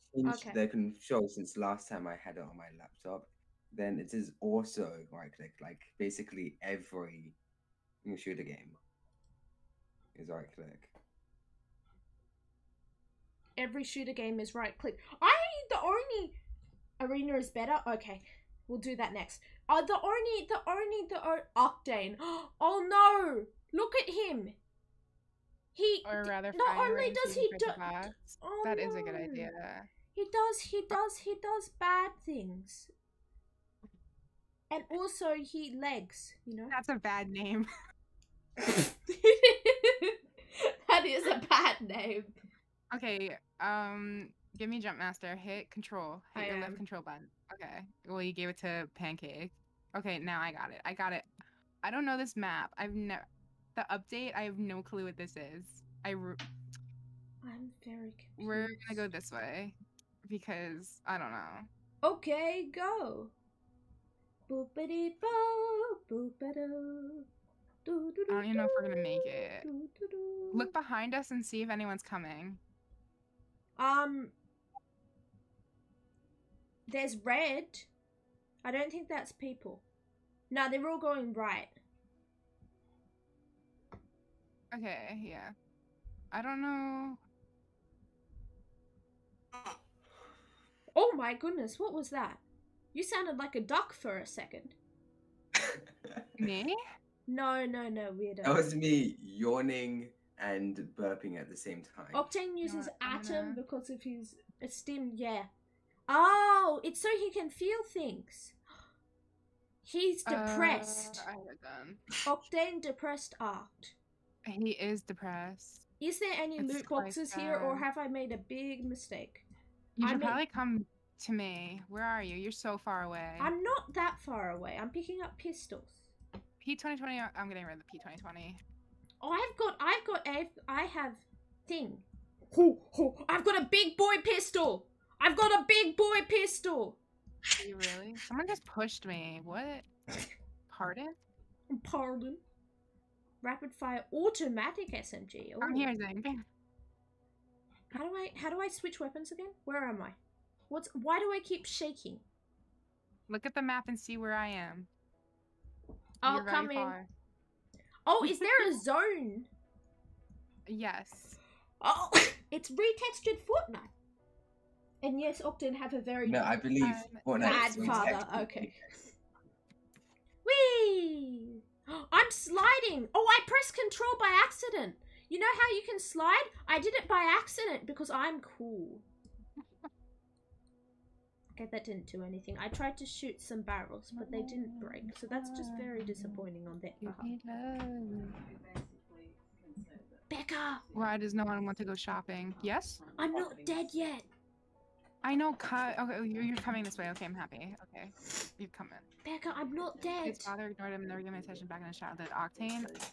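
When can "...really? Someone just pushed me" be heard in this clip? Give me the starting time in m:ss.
2:17.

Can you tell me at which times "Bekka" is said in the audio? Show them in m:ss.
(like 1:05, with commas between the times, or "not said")
3:10, 3:19.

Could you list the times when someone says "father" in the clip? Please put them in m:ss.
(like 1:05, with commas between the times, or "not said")
2:47, 3:20.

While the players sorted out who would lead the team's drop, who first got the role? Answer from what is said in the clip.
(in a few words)
Pancake.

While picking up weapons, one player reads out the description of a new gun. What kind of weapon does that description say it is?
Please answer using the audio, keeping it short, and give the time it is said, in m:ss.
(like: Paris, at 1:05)
Automatic SMG, at 2:24.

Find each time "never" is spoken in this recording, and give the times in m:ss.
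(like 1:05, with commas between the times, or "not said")
0:52, 3:21.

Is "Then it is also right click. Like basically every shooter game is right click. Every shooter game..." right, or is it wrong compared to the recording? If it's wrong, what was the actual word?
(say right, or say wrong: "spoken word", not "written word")
right.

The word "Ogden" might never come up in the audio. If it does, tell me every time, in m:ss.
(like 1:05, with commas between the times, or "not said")
2:45.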